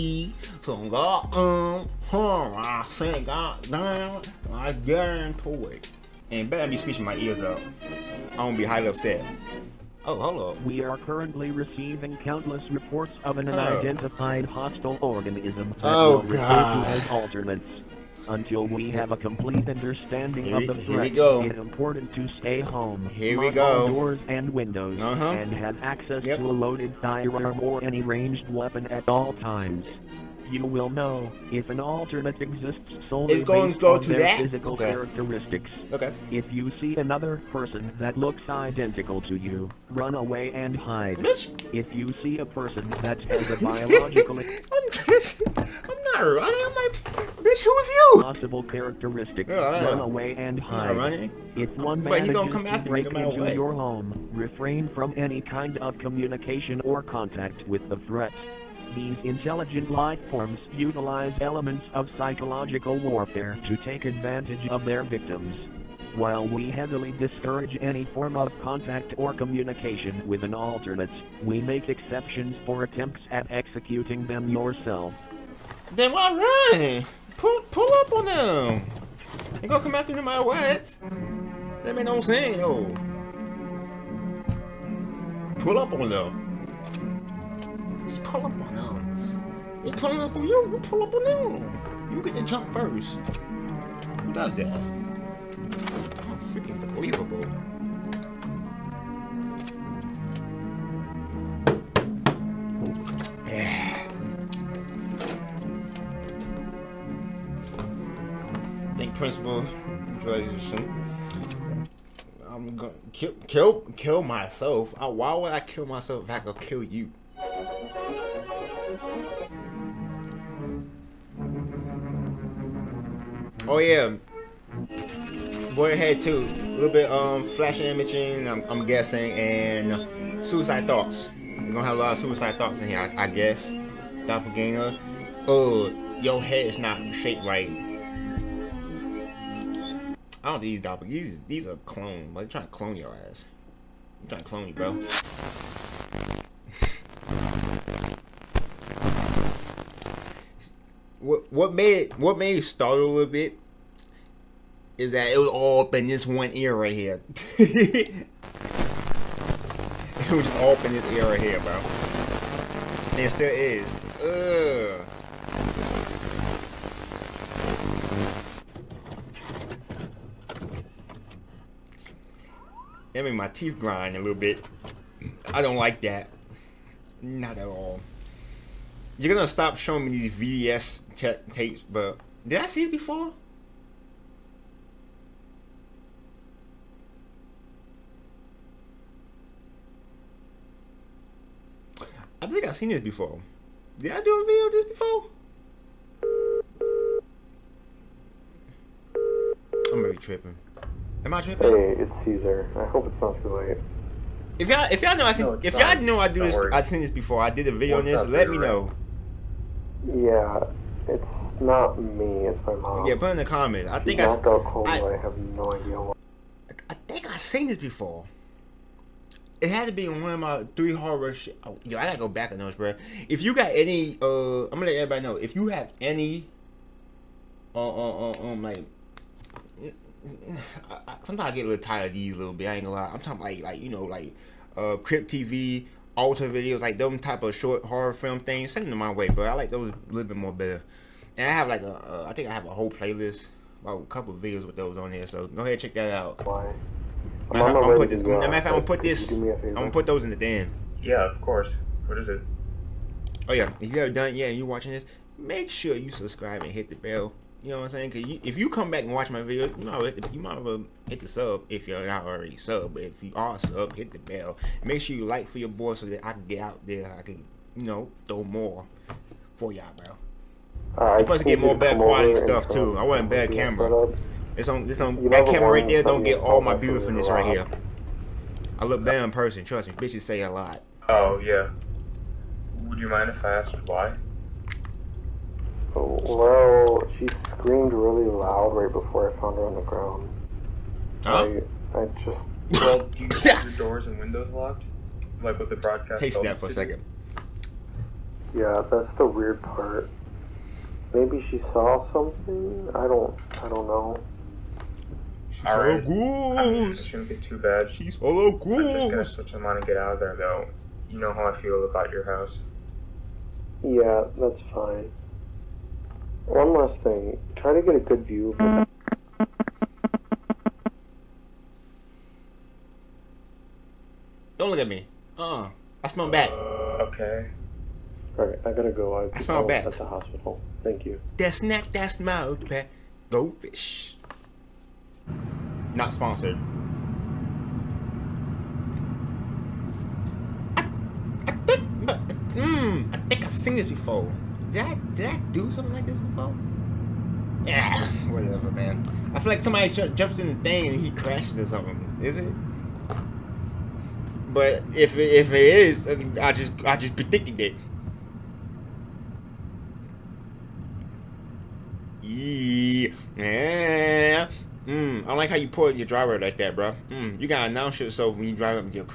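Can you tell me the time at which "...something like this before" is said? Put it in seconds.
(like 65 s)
345 s.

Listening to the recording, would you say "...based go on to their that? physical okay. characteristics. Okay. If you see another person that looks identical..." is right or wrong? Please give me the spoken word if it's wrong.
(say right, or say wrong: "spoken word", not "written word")
right.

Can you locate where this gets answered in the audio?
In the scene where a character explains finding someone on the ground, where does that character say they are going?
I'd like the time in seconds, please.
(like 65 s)
329 s.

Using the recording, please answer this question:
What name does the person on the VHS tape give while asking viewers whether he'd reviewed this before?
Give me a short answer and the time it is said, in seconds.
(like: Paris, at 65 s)
Caesar, at 202 s.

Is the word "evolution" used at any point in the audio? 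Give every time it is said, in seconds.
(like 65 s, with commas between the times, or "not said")
not said.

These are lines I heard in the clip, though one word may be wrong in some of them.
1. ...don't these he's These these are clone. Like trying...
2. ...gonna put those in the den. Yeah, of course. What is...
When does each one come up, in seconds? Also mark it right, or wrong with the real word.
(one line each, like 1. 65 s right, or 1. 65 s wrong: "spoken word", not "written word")
1. 140 s right
2. 249 s right.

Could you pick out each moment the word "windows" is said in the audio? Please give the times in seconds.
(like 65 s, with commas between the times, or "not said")
24 s, 294 s.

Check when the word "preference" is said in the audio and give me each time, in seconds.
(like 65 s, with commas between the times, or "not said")
not said.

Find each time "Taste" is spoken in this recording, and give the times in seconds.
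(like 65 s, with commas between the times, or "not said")
296 s.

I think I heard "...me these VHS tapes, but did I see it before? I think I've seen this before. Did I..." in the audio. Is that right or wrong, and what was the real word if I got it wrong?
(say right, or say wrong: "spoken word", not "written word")
right.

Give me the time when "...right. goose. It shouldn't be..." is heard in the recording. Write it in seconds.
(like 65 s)
305 s.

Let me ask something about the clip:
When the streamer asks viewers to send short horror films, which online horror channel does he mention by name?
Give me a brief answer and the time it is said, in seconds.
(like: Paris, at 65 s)
Crypt TV, at 235 s.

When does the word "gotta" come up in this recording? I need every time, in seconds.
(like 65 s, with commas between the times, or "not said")
222 s, 328 s, 367 s.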